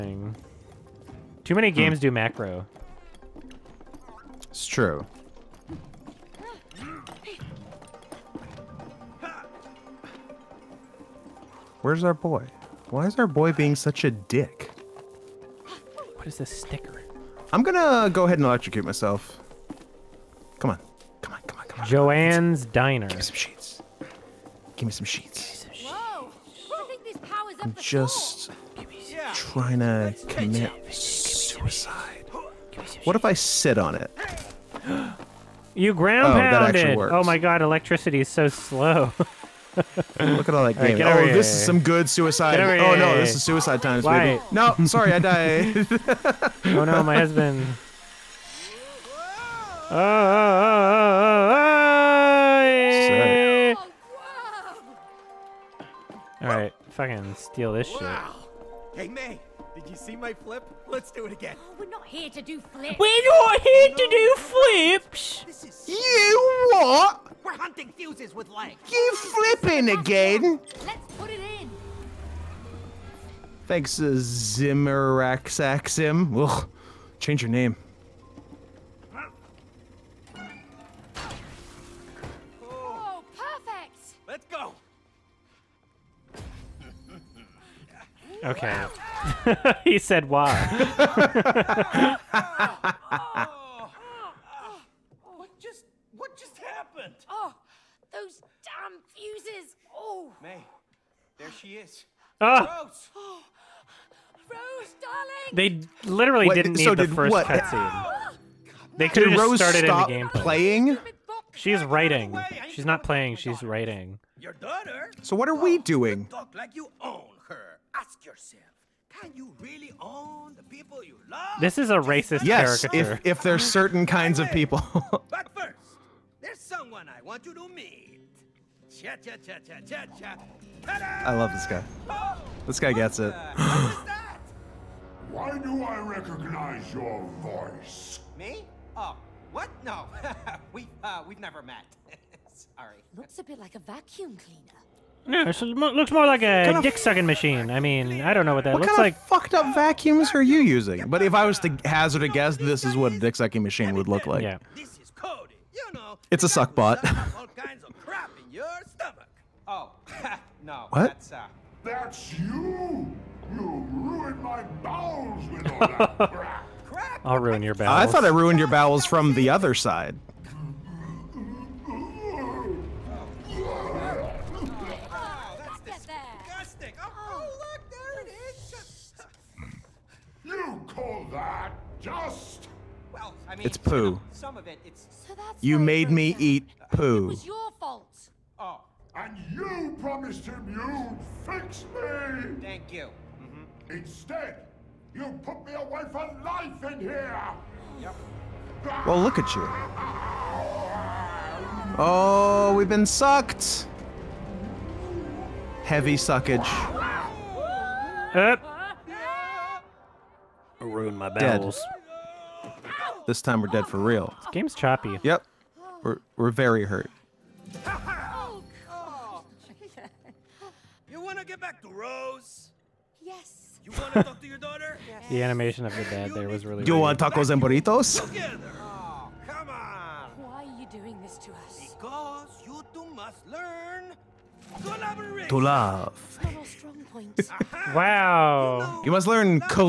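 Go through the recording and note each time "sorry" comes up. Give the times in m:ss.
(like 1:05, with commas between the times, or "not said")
0:44, 2:22.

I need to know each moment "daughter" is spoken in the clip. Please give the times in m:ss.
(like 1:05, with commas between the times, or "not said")
1:54, 3:44.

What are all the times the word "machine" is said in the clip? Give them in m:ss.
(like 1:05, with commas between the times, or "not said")
2:27, 2:33.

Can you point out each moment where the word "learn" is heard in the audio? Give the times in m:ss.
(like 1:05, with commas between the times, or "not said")
3:53, 3:59.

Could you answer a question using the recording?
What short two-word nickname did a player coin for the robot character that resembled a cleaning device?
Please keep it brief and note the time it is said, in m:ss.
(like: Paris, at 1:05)
suck bot, at 2:36.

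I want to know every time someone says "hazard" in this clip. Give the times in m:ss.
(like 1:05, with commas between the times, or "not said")
2:31.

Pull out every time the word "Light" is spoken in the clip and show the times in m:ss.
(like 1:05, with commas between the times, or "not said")
0:44.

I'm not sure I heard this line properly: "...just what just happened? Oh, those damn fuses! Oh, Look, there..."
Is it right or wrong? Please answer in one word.
wrong.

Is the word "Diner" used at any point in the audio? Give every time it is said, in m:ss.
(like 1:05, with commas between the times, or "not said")
0:22.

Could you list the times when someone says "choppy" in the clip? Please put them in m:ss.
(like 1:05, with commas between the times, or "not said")
3:34.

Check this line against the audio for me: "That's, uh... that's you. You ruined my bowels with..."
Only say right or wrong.
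right.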